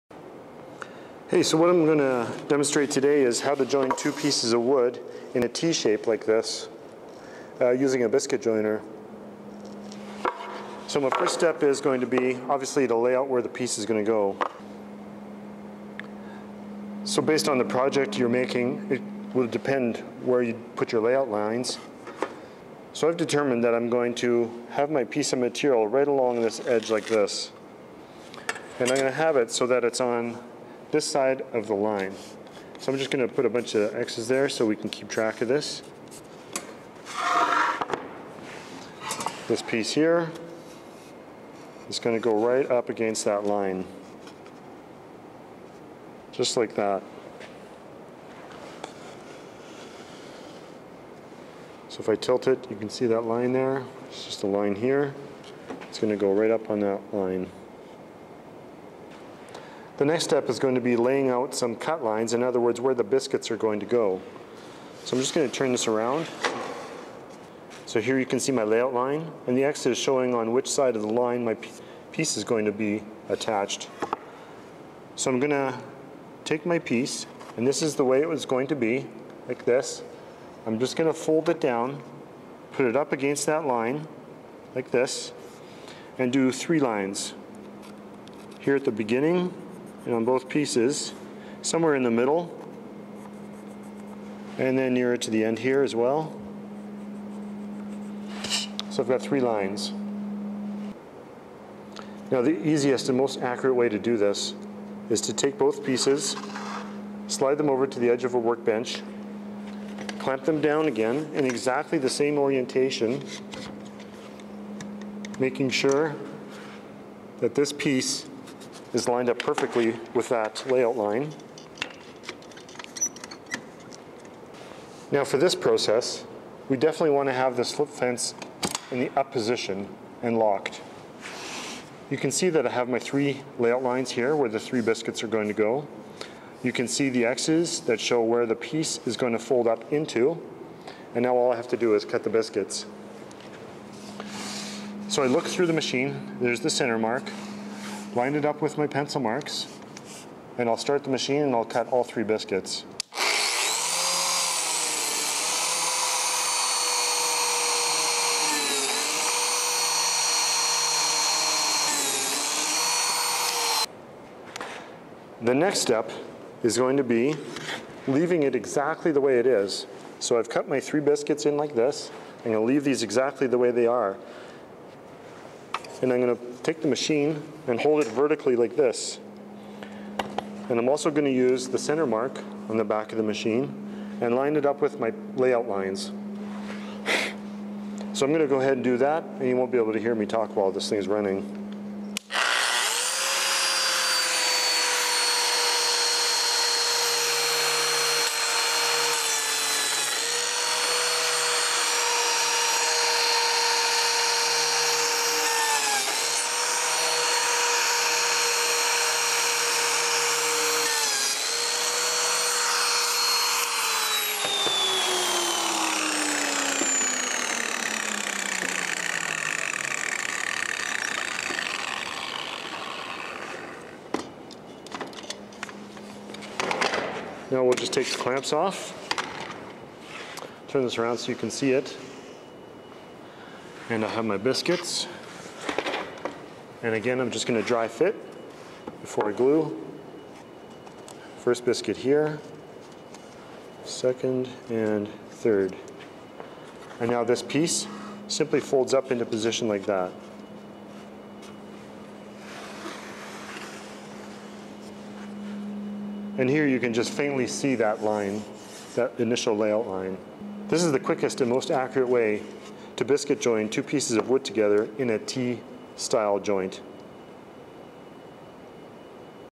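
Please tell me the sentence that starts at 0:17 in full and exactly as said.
So based on the project you're making, it will depend where you put your layout lines.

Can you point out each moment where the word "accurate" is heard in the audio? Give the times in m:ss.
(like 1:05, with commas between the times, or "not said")
1:43, 4:21.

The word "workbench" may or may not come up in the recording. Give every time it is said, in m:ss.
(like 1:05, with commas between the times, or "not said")
1:48.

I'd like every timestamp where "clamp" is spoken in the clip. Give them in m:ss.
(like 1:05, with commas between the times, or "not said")
1:50, 3:48.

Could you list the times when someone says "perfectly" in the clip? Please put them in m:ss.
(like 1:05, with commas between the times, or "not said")
1:59.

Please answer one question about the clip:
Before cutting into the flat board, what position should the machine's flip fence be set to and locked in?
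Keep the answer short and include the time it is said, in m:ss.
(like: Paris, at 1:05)
Up position, at 2:09.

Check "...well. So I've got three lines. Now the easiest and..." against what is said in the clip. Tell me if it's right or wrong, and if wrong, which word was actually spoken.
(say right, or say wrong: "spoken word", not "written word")
right.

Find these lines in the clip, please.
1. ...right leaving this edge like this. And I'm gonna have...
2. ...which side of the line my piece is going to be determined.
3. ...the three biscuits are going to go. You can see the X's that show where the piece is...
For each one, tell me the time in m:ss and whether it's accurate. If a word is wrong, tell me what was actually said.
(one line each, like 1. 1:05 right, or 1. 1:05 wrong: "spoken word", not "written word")
1. 0:25 wrong: "along", not "leaving"
2. 1:10 wrong: "attached", not "determined"
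3. 2:14 right.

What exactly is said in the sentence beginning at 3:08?
So I'm gonna go ahead and do that and you won't be able to hear me talk while this thing's running.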